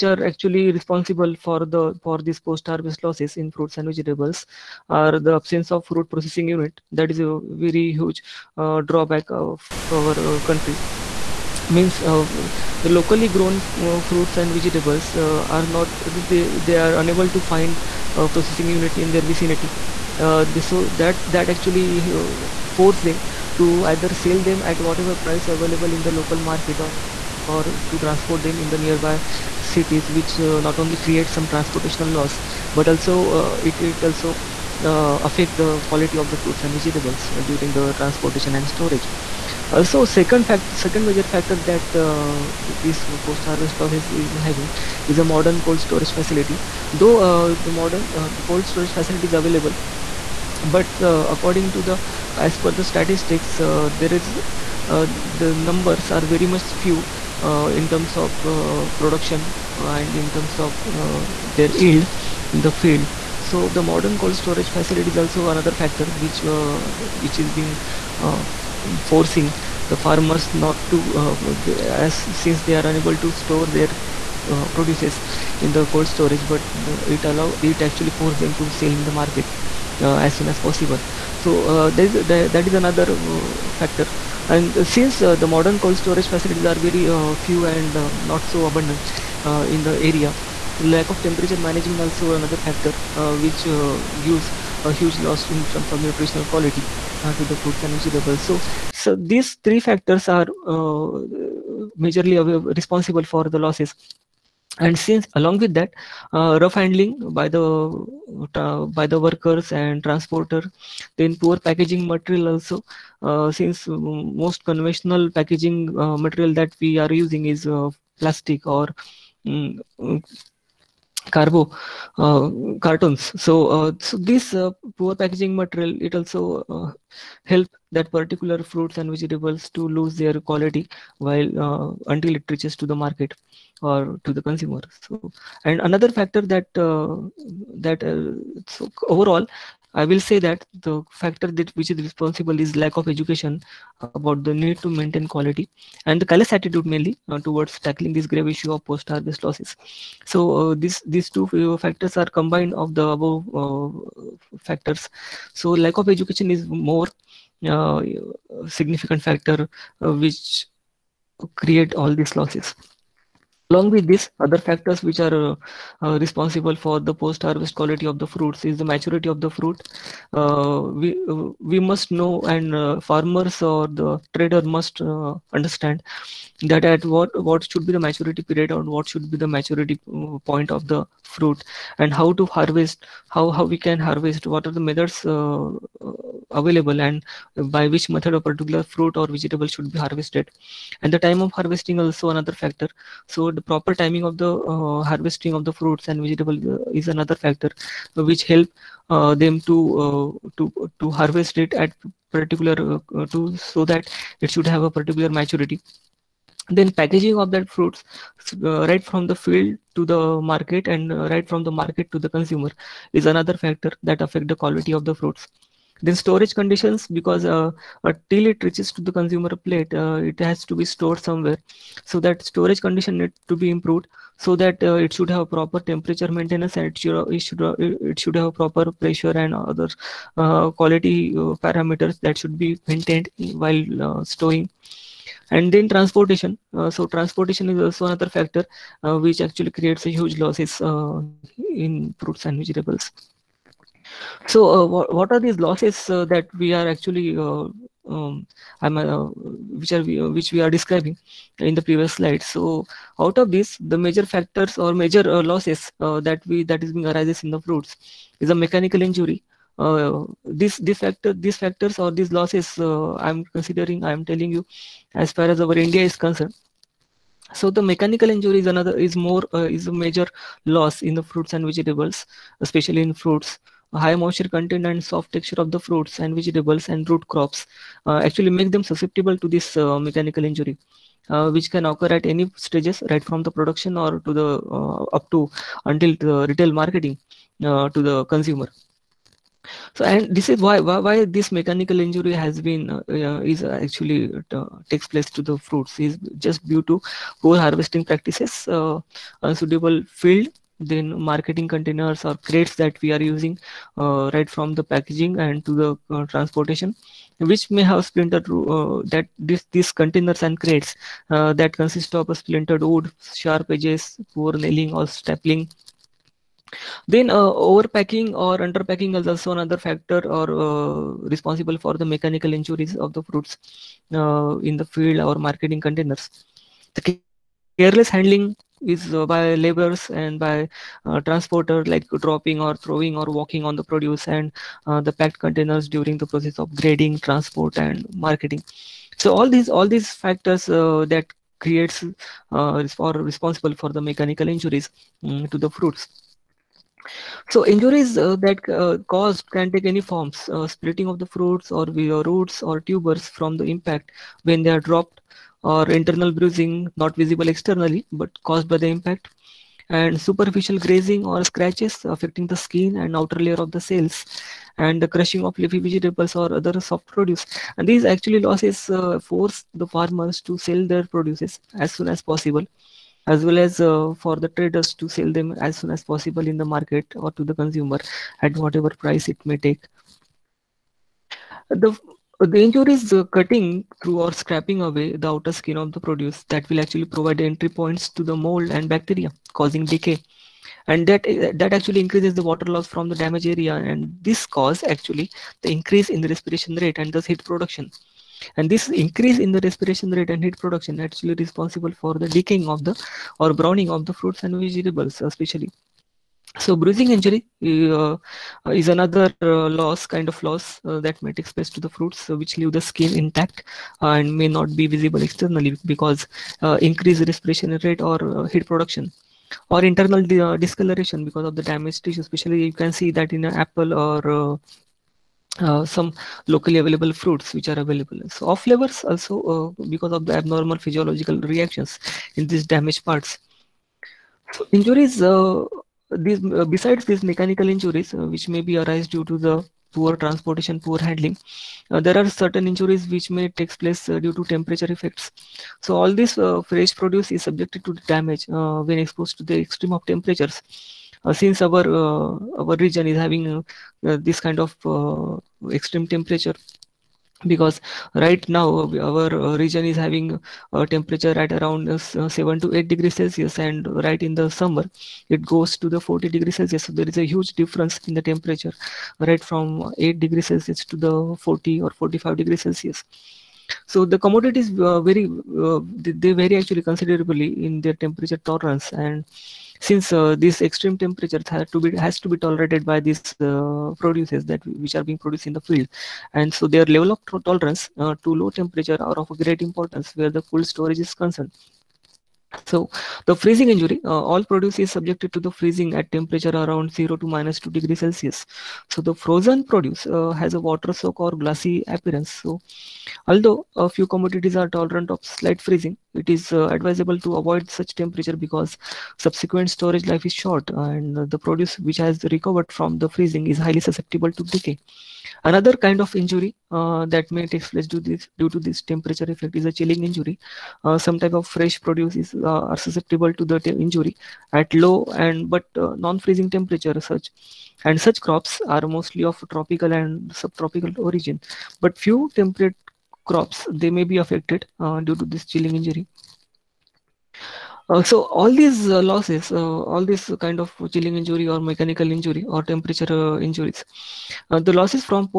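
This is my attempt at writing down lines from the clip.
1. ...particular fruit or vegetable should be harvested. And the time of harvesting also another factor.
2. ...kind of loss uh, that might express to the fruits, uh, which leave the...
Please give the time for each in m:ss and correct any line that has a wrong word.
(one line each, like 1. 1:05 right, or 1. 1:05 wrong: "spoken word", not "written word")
1. 3:08 right
2. 6:50 right.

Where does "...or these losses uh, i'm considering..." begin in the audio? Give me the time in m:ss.
4:21.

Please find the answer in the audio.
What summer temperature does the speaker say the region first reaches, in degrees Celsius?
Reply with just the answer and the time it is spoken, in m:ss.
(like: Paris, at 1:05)
40 degrees Celsius, at 7:46.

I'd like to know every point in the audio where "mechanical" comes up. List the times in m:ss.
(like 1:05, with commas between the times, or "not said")
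4:18, 4:27, 4:39, 4:51, 5:22, 5:44, 7:17, 9:01.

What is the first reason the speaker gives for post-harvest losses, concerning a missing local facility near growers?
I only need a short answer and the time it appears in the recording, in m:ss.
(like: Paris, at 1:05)
Absence of fruit processing unit, at 0:05.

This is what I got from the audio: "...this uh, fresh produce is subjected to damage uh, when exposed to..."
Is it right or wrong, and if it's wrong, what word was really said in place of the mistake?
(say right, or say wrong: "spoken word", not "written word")
right.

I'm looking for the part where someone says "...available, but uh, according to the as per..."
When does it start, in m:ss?
0:49.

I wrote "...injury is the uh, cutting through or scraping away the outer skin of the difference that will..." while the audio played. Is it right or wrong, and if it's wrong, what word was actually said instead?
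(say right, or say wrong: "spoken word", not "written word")
wrong: "produce", not "difference".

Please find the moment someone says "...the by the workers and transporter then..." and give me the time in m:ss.
1:47.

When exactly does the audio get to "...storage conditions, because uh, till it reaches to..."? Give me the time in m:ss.
3:36.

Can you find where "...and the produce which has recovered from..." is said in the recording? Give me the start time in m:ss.
8:30.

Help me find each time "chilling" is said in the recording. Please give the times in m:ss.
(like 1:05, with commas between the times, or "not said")
8:39, 8:55, 9:00.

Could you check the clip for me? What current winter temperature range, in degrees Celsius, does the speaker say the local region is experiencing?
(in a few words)
7 to 8 degrees Celsius.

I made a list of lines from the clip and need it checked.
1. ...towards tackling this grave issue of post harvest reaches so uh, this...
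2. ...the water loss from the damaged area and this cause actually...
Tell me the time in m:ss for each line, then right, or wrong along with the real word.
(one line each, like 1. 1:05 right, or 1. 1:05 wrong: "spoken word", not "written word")
1. 2:27 wrong: "losses", not "reaches"
2. 6:32 right.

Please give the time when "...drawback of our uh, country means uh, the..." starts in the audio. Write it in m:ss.
0:08.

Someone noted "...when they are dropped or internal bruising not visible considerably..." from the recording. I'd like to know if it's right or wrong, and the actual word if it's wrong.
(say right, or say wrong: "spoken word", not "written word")
wrong: "externally", not "considerably".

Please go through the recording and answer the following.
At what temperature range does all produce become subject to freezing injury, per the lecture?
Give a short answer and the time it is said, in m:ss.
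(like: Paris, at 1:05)
0 to -2 degrees Celsius, at 8:16.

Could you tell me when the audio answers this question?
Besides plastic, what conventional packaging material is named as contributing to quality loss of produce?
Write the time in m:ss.
2:02.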